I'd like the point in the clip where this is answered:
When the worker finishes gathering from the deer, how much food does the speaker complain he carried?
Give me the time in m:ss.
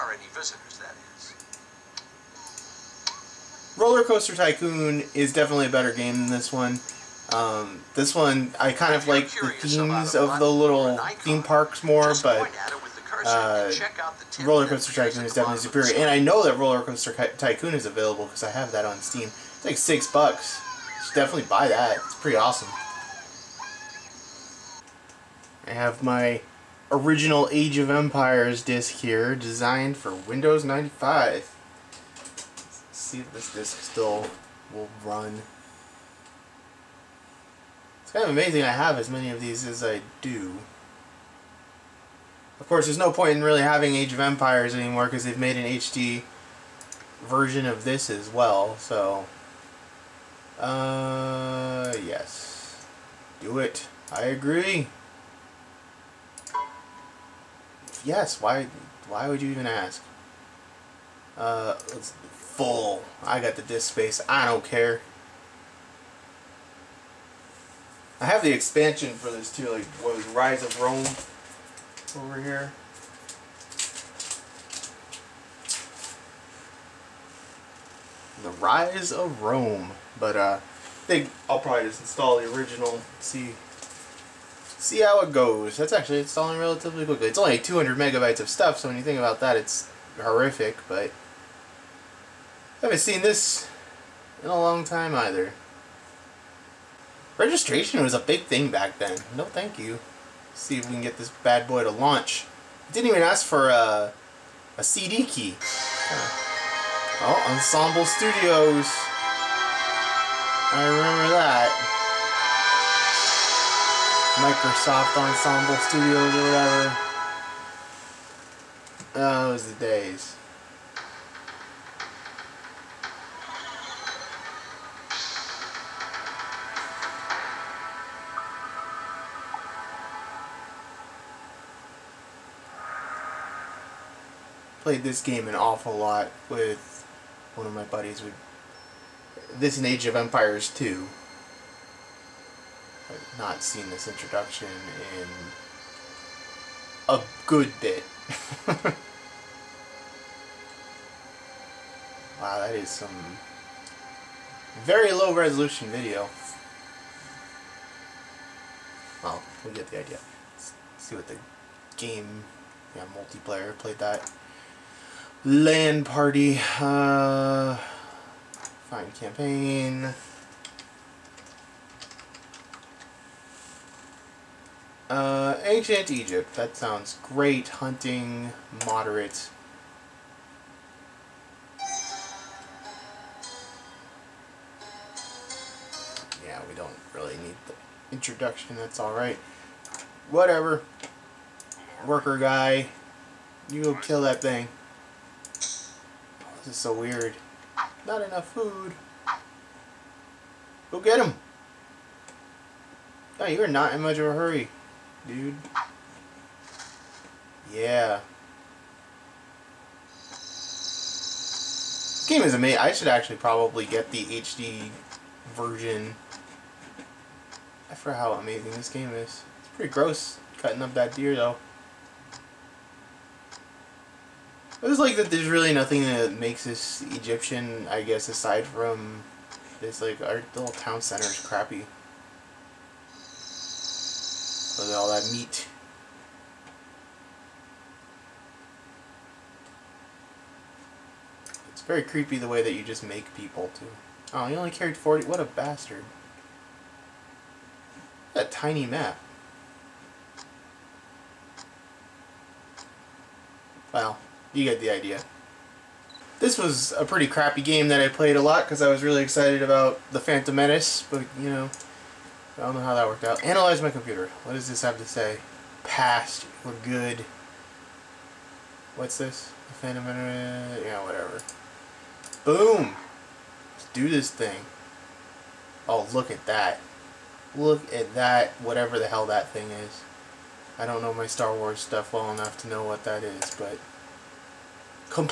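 4:04.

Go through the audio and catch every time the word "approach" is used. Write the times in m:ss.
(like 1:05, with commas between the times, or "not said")
not said.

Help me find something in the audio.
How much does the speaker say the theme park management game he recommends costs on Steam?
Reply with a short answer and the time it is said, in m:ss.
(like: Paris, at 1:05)
6 bucks, at 0:19.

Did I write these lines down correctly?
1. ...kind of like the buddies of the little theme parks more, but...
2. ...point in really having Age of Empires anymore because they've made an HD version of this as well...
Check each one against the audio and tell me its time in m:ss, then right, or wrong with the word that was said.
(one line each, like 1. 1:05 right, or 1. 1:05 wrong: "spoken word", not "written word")
1. 0:08 wrong: "themes", not "buddies"
2. 0:43 right.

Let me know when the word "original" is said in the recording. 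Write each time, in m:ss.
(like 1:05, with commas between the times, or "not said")
0:26, 1:22.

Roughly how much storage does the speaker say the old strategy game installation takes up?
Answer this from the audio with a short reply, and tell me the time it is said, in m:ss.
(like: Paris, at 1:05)
200 megabytes, at 1:27.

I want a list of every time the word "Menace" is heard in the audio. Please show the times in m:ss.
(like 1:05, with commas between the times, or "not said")
4:20, 4:30.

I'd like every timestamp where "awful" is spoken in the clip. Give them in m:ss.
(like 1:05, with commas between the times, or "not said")
2:15.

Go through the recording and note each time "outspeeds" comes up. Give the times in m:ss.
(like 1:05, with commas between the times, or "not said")
not said.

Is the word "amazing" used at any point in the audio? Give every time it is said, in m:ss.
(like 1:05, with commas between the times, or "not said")
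0:38, 3:32, 3:38.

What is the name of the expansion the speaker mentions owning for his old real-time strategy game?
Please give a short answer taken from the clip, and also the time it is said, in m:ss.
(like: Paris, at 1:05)
The Rise of Rome, at 1:18.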